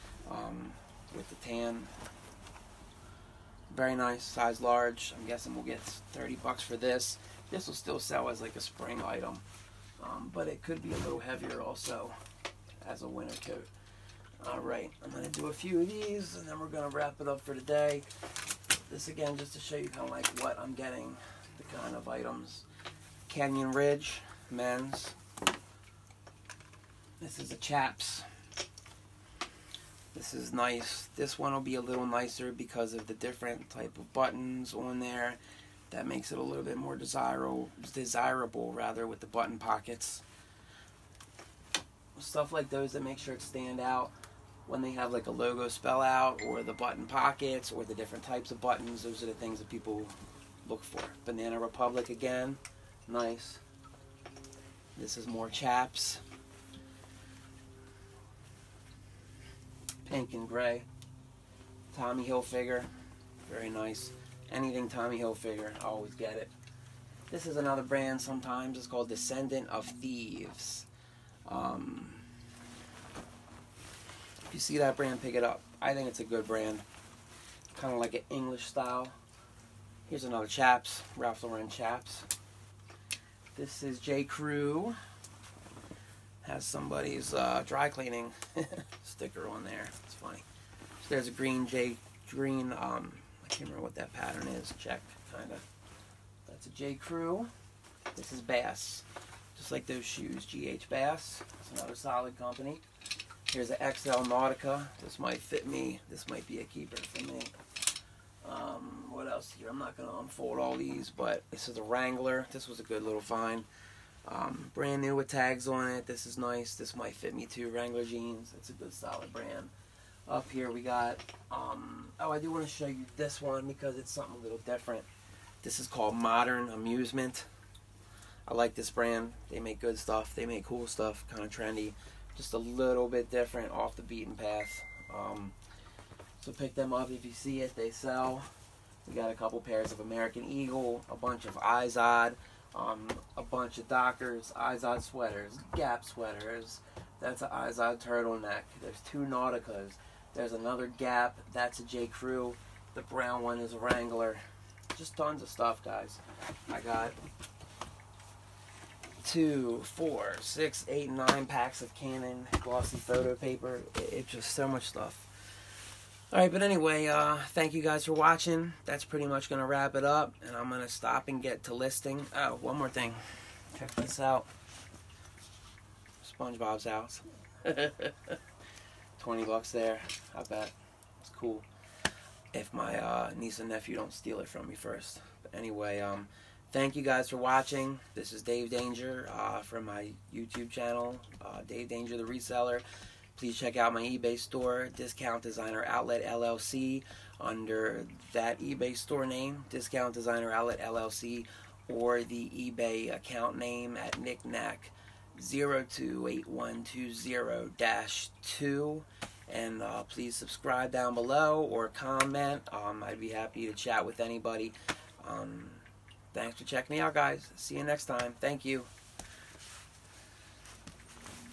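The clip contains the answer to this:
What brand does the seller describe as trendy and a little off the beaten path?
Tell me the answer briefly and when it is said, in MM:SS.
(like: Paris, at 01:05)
Modern Amusement, at 02:06.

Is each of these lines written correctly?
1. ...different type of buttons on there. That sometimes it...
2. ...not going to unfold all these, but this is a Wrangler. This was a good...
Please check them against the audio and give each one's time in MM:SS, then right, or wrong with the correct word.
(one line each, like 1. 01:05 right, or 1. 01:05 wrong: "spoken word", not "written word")
1. 00:33 wrong: "makes", not "sometimes"
2. 01:49 right.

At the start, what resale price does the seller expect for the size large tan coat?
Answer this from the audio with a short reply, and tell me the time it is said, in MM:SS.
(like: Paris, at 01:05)
$30, at 00:05.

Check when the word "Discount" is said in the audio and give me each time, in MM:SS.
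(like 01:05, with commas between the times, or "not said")
03:14, 03:19.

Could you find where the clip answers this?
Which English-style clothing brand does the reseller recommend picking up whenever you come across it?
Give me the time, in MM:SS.
01:09.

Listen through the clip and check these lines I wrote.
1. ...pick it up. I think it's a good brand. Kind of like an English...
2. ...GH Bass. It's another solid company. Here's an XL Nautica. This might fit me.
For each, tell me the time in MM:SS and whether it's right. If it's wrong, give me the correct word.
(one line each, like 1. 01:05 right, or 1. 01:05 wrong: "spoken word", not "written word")
1. 01:15 right
2. 01:40 right.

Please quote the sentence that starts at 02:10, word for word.
They make cool stuff, kind of trendy just a little bit different off the beaten path.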